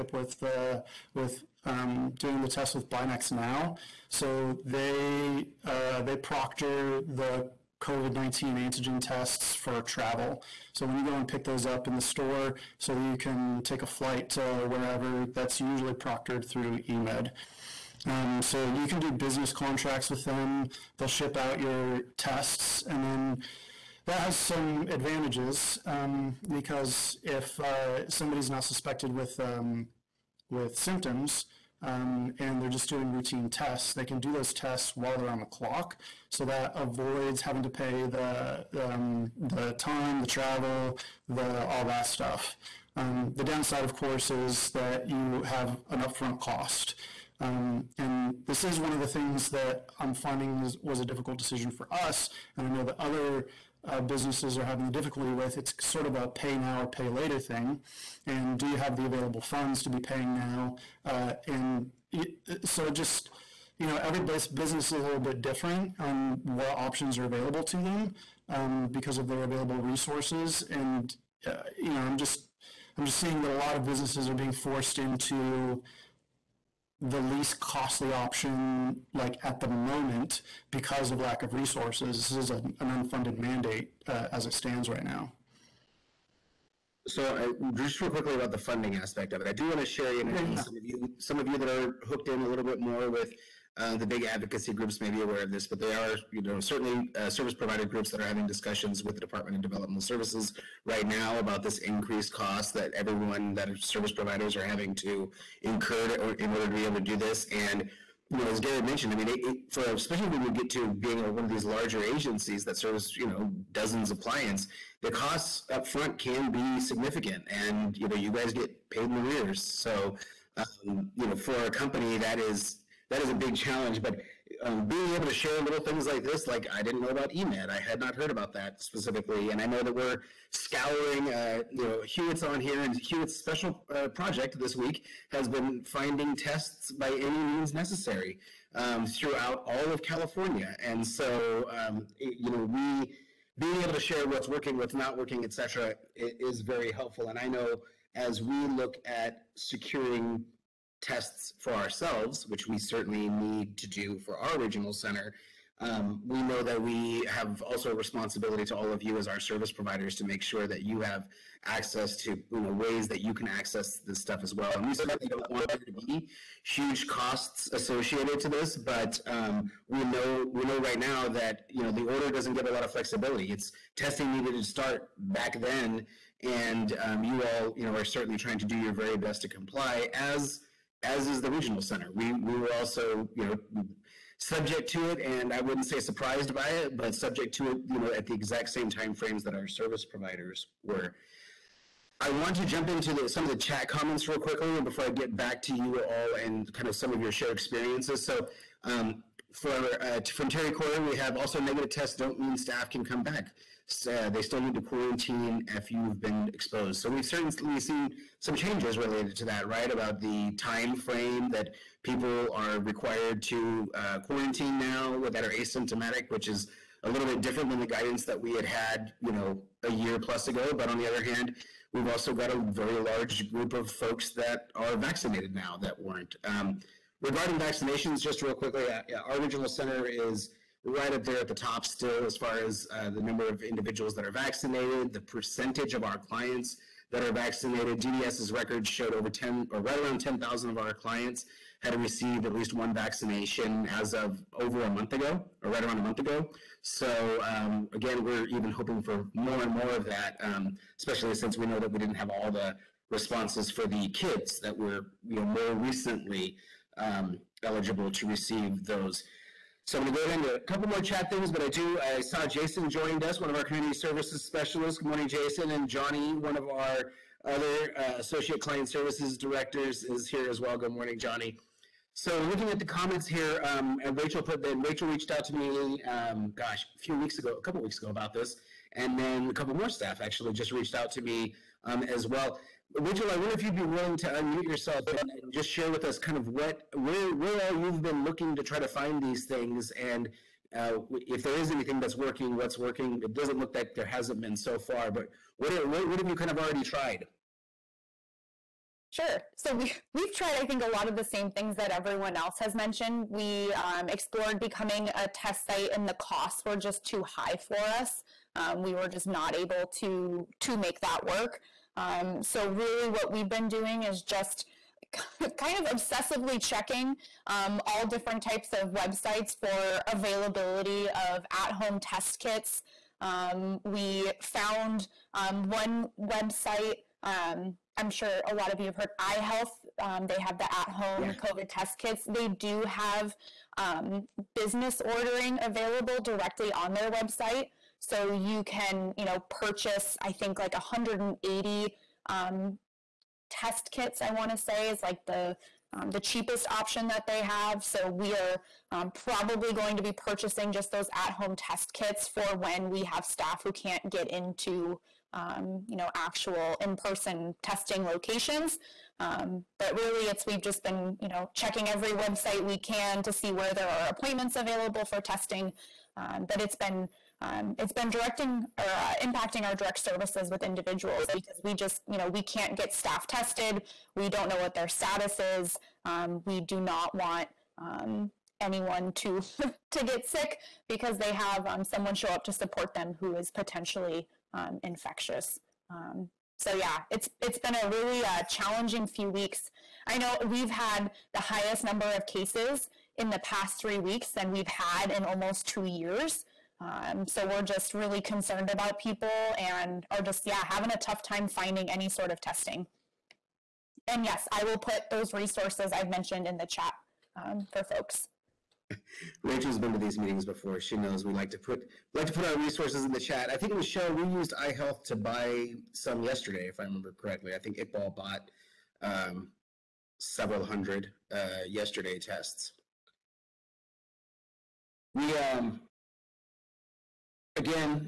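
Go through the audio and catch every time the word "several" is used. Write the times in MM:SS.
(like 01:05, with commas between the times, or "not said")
07:00.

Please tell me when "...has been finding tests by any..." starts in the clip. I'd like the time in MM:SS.
02:15.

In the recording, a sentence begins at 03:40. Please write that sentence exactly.
But on the other hand, we've also got a very large group of folks that are vaccinated now that weren't.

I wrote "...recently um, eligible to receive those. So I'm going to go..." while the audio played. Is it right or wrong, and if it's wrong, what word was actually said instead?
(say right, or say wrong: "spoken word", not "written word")
right.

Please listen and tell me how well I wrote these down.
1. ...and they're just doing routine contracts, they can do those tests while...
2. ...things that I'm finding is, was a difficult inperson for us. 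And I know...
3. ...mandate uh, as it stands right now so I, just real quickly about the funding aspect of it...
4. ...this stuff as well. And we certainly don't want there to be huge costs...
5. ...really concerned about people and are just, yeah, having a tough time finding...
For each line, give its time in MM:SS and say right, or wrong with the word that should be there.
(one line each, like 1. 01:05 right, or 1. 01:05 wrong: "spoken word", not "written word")
1. 00:32 wrong: "tests", not "contracts"
2. 00:49 wrong: "decision", not "inperson"
3. 01:23 right
4. 02:44 right
5. 06:37 right.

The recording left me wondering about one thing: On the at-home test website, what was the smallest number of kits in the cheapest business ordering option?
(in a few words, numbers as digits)
180.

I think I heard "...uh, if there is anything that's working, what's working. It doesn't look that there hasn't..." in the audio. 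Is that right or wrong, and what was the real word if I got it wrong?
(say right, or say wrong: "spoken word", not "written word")
right.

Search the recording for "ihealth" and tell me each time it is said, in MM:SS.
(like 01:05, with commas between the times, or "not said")
05:29, 06:54.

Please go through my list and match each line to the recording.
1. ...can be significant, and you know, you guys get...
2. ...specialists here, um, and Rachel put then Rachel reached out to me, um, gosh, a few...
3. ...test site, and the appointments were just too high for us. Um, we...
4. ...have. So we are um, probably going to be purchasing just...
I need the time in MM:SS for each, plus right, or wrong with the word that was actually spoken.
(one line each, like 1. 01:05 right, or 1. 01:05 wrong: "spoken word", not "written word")
1. 01:56 right
2. 04:32 wrong: "comments", not "specialists"
3. 05:05 wrong: "costs", not "appointments"
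4. 05:47 right.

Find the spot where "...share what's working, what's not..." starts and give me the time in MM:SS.
02:23.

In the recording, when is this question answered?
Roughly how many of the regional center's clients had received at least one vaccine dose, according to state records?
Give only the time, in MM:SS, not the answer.
04:00.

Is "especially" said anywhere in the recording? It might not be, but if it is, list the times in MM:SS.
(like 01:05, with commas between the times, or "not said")
01:49, 04:10.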